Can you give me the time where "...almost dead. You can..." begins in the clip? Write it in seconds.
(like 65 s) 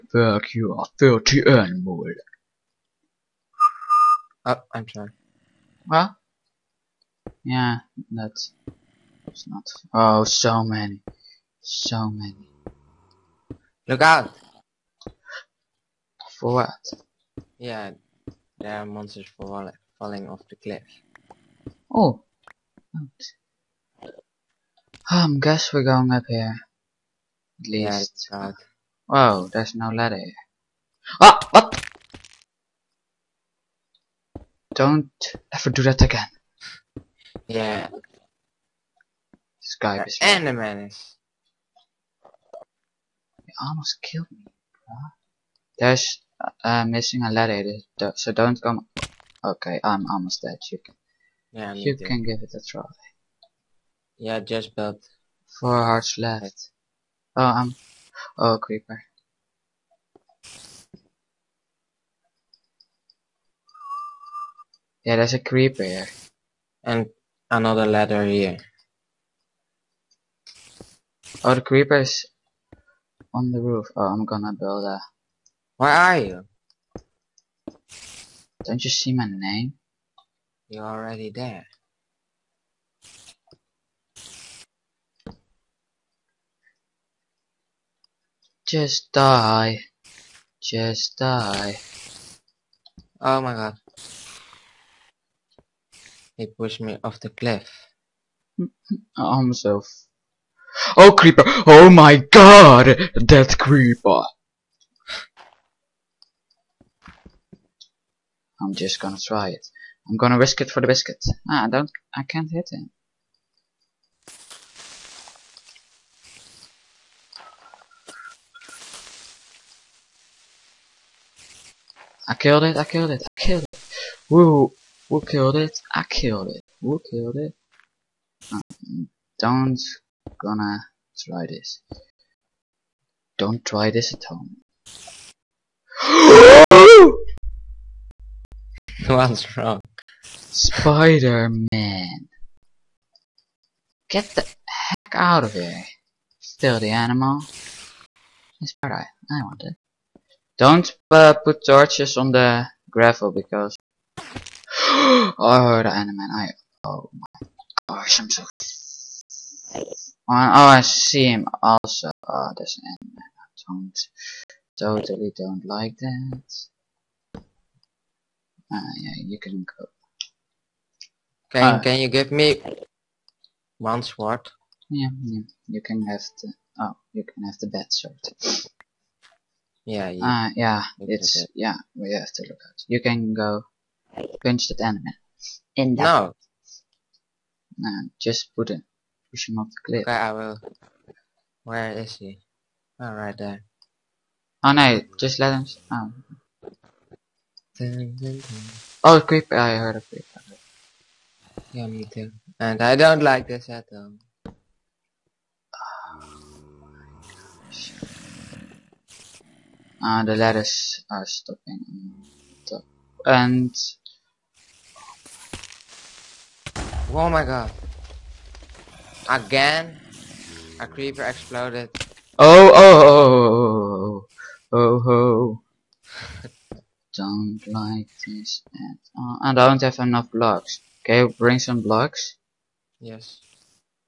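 50 s.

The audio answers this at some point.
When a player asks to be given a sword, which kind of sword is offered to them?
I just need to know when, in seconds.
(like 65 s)
177 s.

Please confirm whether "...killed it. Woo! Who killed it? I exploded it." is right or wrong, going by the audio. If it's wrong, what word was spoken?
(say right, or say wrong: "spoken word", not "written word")
wrong: "killed", not "exploded".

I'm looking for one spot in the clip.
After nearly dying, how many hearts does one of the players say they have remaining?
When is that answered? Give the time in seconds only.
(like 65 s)
55 s.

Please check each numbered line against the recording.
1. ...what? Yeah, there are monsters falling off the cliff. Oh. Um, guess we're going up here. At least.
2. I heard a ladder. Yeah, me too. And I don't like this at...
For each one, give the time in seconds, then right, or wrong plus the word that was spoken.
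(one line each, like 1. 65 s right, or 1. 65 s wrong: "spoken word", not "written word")
1. 16 s right
2. 199 s wrong: "creeper", not "ladder".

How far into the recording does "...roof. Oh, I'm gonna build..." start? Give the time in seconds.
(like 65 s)
73 s.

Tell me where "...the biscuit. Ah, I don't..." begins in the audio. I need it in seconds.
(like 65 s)
110 s.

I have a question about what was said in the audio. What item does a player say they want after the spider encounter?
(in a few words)
Spider-Eye.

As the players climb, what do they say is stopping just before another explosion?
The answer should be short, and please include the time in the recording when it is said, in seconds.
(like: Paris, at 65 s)
the ladders, at 210 s.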